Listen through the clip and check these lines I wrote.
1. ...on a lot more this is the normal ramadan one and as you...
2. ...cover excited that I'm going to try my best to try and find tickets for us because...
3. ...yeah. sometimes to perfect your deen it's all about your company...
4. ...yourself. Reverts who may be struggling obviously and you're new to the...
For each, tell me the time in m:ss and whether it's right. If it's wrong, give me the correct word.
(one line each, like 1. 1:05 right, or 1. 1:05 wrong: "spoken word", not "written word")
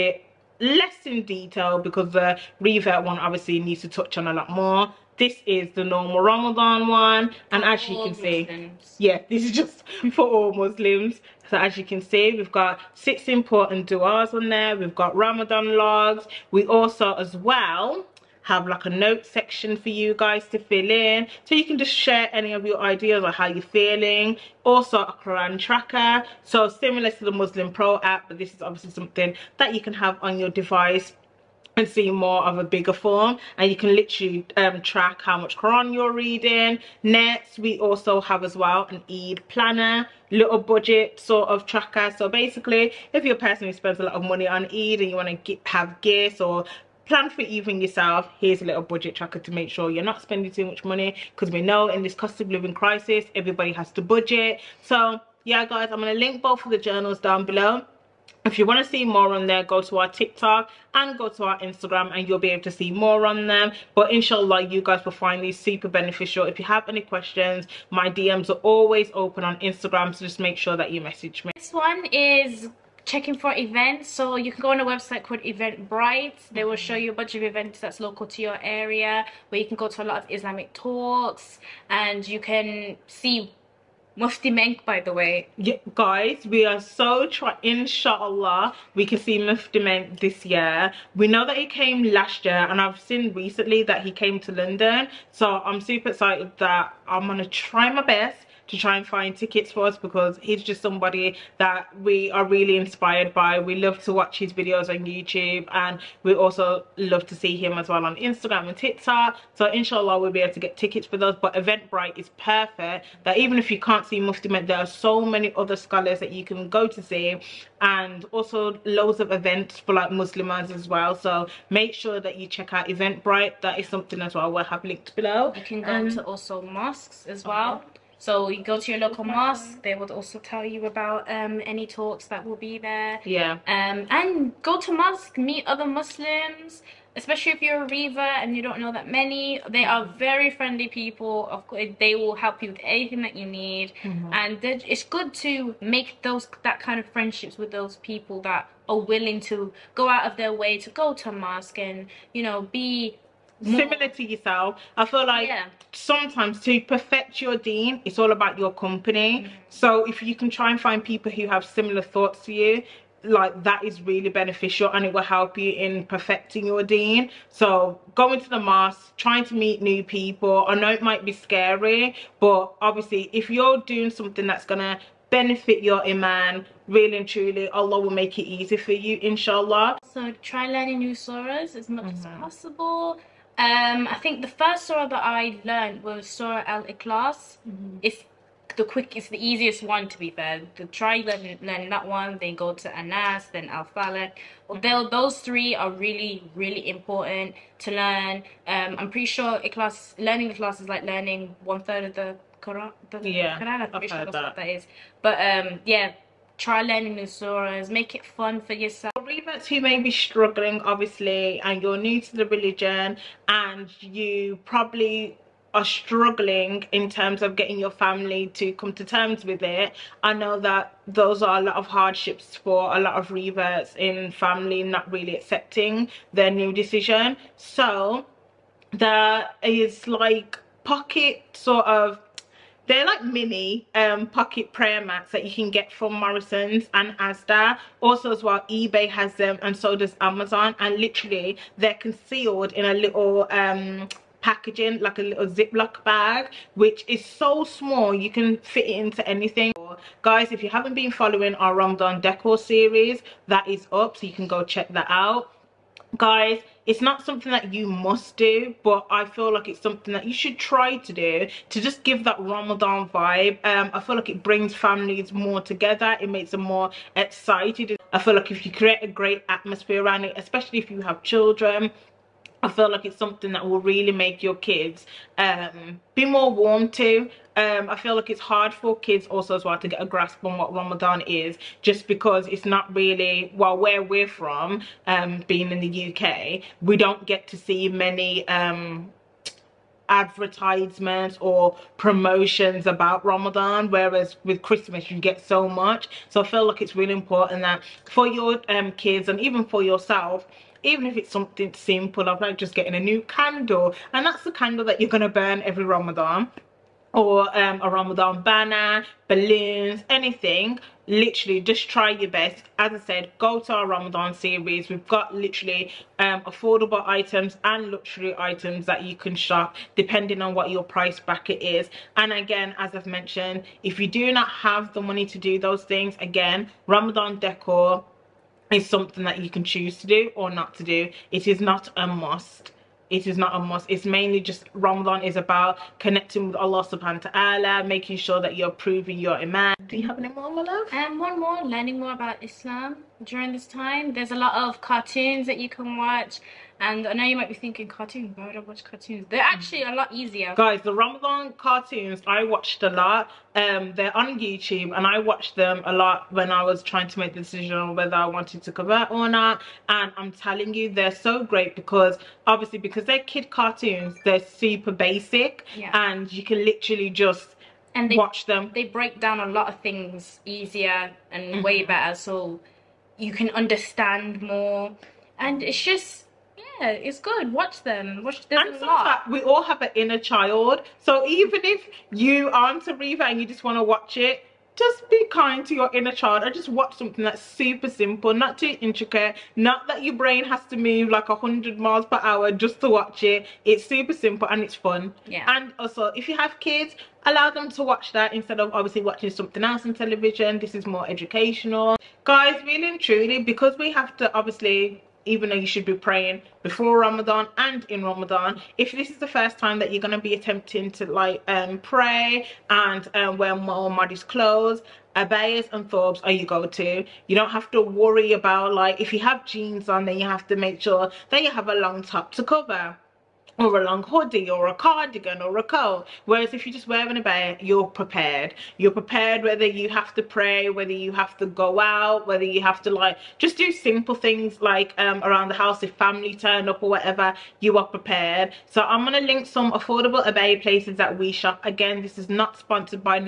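1. 0:04 right
2. 1:35 wrong: "super", not "cover"
3. 2:35 right
4. 3:28 right.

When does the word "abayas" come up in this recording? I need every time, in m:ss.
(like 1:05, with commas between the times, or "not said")
6:55, 7:20.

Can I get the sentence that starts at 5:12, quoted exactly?
As I said, go to our Ramadan series.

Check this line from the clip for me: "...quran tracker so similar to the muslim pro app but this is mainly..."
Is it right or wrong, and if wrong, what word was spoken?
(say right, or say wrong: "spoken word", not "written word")
wrong: "obviously", not "mainly".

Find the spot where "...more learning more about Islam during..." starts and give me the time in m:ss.
5:41.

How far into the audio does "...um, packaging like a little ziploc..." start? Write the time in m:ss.
4:03.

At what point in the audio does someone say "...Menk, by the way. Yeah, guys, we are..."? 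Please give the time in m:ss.
1:24.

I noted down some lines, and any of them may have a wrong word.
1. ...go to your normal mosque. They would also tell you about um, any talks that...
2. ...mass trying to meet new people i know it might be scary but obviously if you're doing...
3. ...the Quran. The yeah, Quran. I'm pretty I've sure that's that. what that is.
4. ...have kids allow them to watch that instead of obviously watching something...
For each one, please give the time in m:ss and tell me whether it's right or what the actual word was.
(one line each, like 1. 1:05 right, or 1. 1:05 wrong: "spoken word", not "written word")
1. 2:08 wrong: "local", not "normal"
2. 2:48 right
3. 3:22 right
4. 6:36 right.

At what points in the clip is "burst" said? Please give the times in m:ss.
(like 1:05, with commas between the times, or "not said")
not said.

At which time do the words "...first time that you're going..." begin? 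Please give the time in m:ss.
6:49.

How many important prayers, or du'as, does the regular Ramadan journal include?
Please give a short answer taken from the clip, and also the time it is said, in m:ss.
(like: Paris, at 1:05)
6, at 0:12.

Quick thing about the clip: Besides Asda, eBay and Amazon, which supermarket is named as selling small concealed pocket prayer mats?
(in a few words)
Morrison's.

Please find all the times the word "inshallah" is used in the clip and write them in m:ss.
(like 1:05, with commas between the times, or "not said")
1:04, 1:27, 1:49, 2:59.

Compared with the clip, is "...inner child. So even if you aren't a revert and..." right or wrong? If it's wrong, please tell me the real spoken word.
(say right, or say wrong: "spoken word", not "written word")
right.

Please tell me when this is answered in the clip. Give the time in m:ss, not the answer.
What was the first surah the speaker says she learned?
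3:06.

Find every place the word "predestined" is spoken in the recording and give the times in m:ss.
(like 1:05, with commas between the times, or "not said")
not said.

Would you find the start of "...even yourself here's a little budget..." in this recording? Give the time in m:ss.
0:47.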